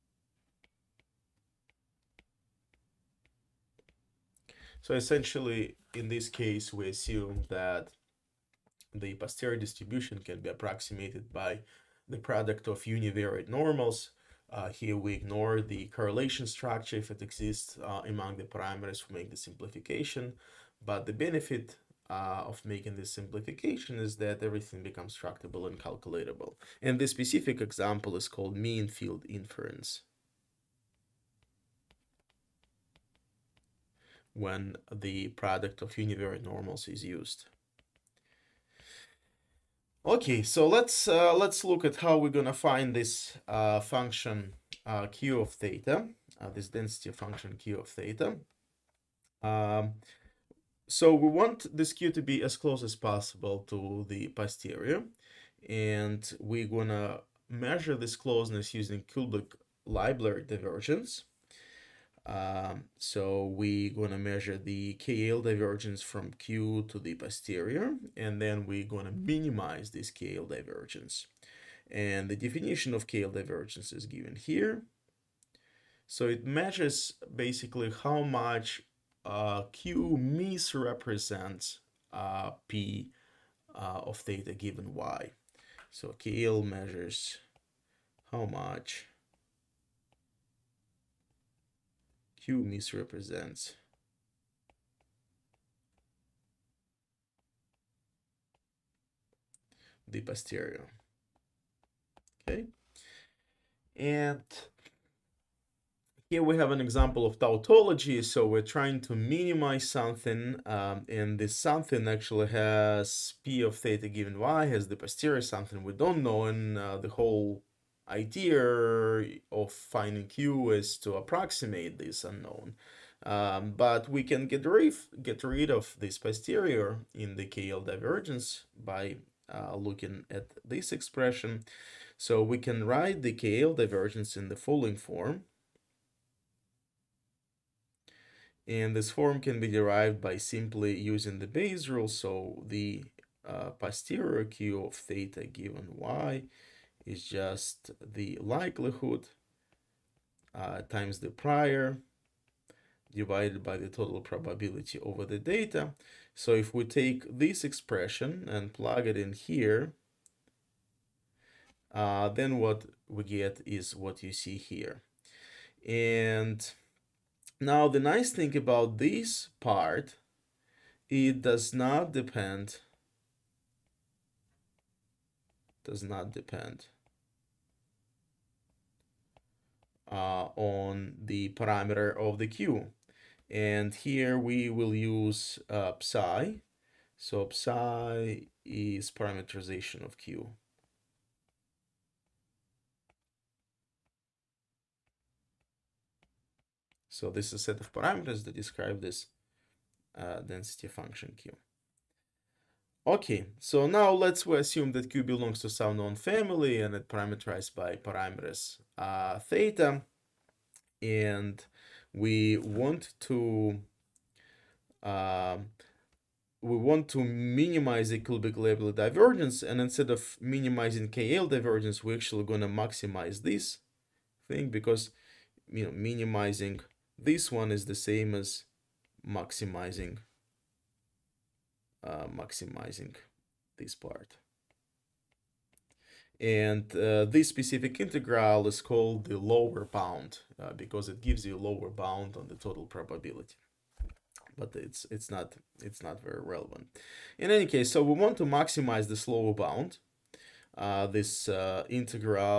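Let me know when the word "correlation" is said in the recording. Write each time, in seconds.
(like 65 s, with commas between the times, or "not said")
15 s.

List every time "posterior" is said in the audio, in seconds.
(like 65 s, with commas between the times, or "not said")
9 s, 54 s, 67 s, 100 s, 114 s, 126 s, 143 s.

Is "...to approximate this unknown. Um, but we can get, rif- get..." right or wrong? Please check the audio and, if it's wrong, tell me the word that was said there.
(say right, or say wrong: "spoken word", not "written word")
right.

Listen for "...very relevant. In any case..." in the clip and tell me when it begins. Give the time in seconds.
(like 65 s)
246 s.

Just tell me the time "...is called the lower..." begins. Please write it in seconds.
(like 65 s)
238 s.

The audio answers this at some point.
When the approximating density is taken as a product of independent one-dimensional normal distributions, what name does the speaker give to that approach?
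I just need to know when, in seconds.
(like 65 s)
28 s.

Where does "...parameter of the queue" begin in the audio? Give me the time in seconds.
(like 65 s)
181 s.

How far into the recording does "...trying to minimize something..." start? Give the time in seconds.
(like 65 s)
108 s.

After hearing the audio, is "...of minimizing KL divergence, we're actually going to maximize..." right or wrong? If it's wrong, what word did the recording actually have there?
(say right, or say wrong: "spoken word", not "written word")
right.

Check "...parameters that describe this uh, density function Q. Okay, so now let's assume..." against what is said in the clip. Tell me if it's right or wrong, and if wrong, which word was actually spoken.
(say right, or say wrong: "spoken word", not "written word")
right.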